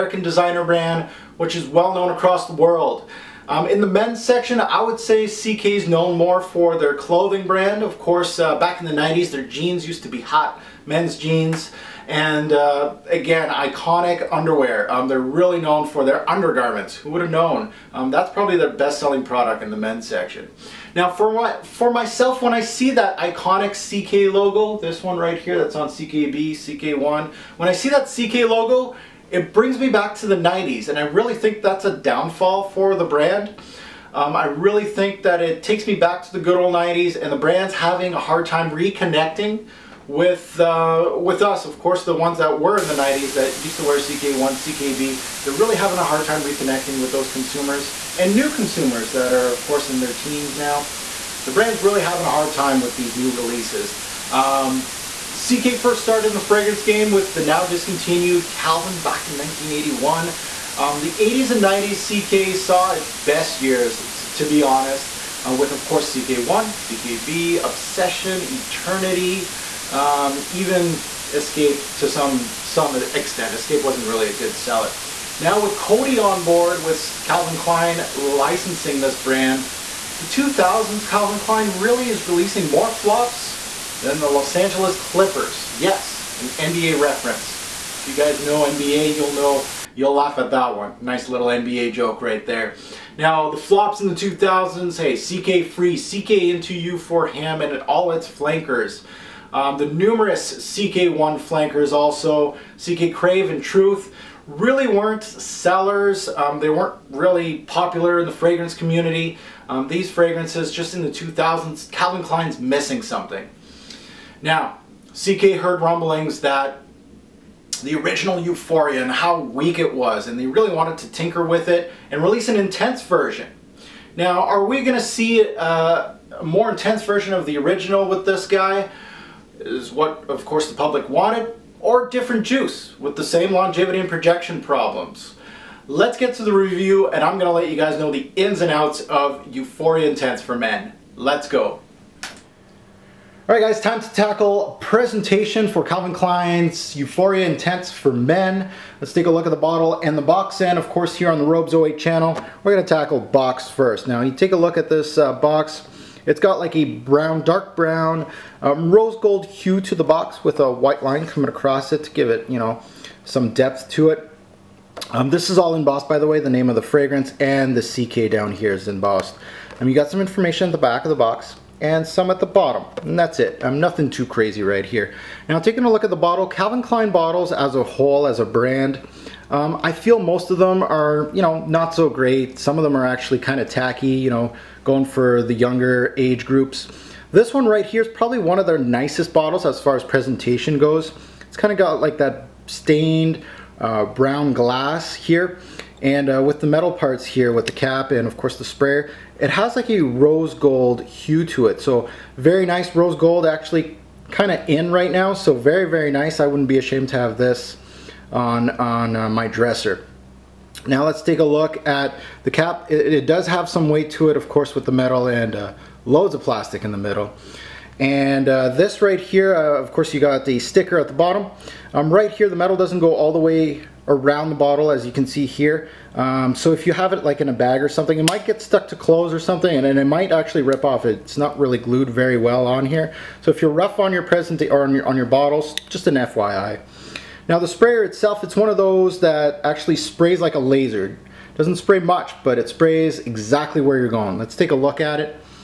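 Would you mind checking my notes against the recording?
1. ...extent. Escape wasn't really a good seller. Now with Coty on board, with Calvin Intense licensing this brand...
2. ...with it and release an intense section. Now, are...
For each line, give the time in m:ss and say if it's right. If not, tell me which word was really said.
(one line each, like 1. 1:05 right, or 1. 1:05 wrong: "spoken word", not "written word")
1. 1:13 wrong: "Klein", not "Intense"
2. 2:01 wrong: "version", not "section".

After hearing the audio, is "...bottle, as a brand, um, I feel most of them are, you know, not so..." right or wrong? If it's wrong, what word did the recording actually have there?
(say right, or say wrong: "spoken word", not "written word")
wrong: "whole", not "bottle".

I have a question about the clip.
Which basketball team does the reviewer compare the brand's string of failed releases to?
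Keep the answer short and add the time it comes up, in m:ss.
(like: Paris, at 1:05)
Los Angeles Clippers, at 1:24.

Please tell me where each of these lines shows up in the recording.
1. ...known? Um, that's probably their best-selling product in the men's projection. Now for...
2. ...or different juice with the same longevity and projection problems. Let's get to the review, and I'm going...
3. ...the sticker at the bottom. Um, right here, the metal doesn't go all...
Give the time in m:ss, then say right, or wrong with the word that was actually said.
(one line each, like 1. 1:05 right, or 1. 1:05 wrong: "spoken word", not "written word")
1. 0:17 wrong: "section", not "projection"
2. 2:11 right
3. 3:40 right.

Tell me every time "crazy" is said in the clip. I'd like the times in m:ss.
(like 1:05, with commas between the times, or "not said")
2:54.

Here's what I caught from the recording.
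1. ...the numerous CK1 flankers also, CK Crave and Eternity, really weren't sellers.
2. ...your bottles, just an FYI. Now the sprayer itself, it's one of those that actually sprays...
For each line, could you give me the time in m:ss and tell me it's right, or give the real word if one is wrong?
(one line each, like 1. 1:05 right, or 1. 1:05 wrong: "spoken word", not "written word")
1. 1:39 wrong: "Truth", not "Eternity"
2. 3:55 right.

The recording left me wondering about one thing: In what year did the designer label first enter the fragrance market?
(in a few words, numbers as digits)
1981.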